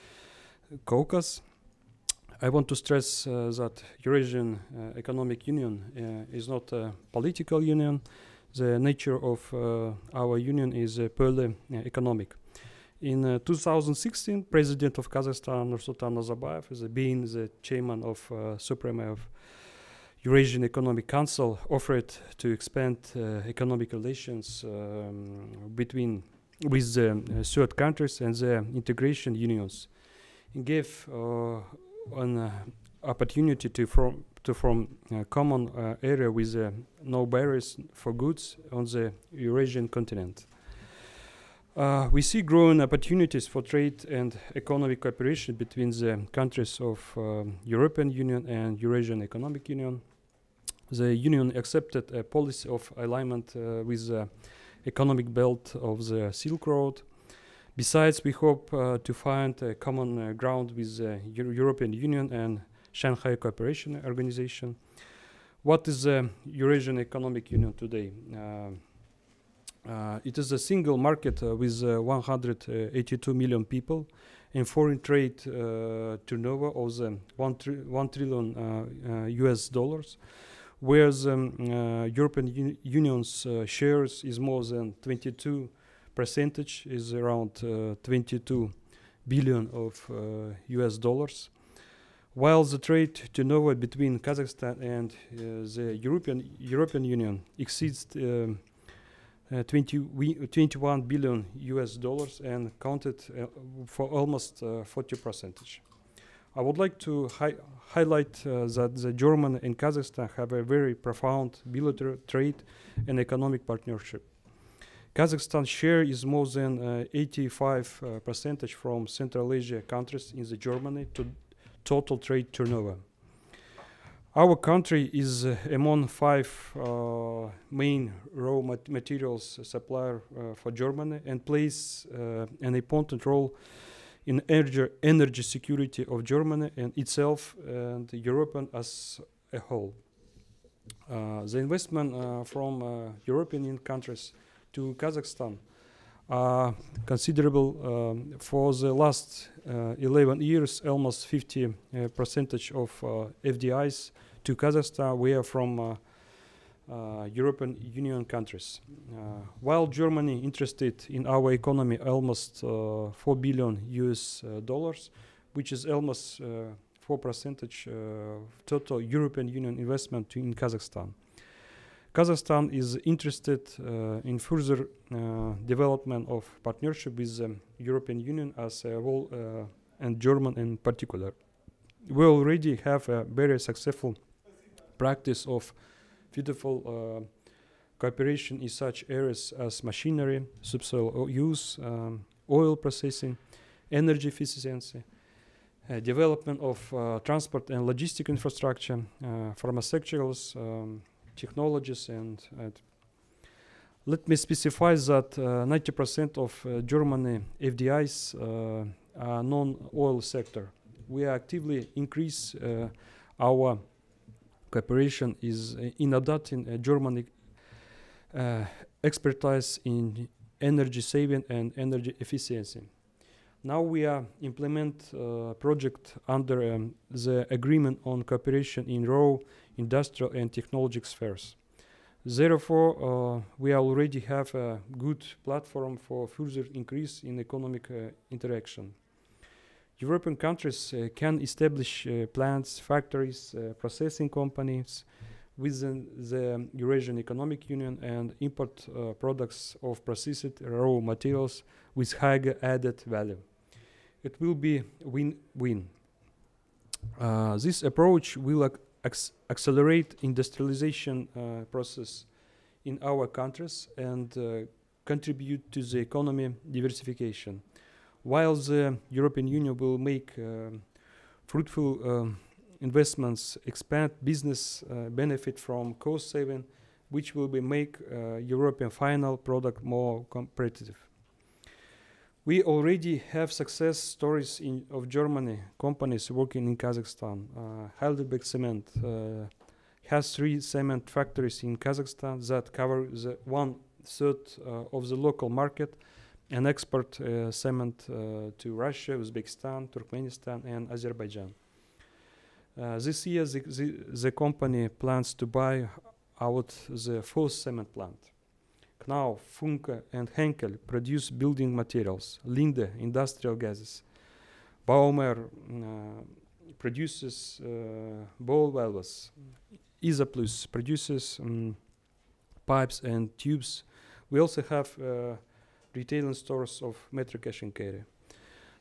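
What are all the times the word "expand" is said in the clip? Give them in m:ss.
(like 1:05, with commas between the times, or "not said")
0:22, 4:33.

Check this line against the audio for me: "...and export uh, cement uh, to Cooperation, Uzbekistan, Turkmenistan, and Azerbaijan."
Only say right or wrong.
wrong.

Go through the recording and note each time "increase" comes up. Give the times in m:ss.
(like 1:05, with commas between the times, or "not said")
3:31, 3:56.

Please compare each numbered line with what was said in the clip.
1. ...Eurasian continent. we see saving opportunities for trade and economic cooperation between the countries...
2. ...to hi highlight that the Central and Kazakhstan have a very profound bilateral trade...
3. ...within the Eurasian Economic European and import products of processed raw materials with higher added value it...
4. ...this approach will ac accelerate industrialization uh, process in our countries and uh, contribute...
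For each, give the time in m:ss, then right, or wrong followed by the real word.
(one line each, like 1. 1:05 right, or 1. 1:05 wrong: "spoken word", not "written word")
1. 0:39 wrong: "growing", not "saving"
2. 1:47 wrong: "German", not "Central"
3. 4:05 wrong: "Union", not "European"
4. 4:17 right.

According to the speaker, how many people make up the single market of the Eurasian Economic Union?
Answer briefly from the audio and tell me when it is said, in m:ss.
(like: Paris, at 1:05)
182 million, at 1:12.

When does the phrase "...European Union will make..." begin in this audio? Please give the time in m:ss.
4:29.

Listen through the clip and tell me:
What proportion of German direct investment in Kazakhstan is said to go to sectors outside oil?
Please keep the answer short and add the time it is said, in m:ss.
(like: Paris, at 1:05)
90%, at 3:25.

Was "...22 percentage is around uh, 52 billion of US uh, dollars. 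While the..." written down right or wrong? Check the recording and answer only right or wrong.
wrong.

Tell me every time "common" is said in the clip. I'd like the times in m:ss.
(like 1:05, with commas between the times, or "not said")
0:35, 0:59.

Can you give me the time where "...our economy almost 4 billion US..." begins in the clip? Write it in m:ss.
2:41.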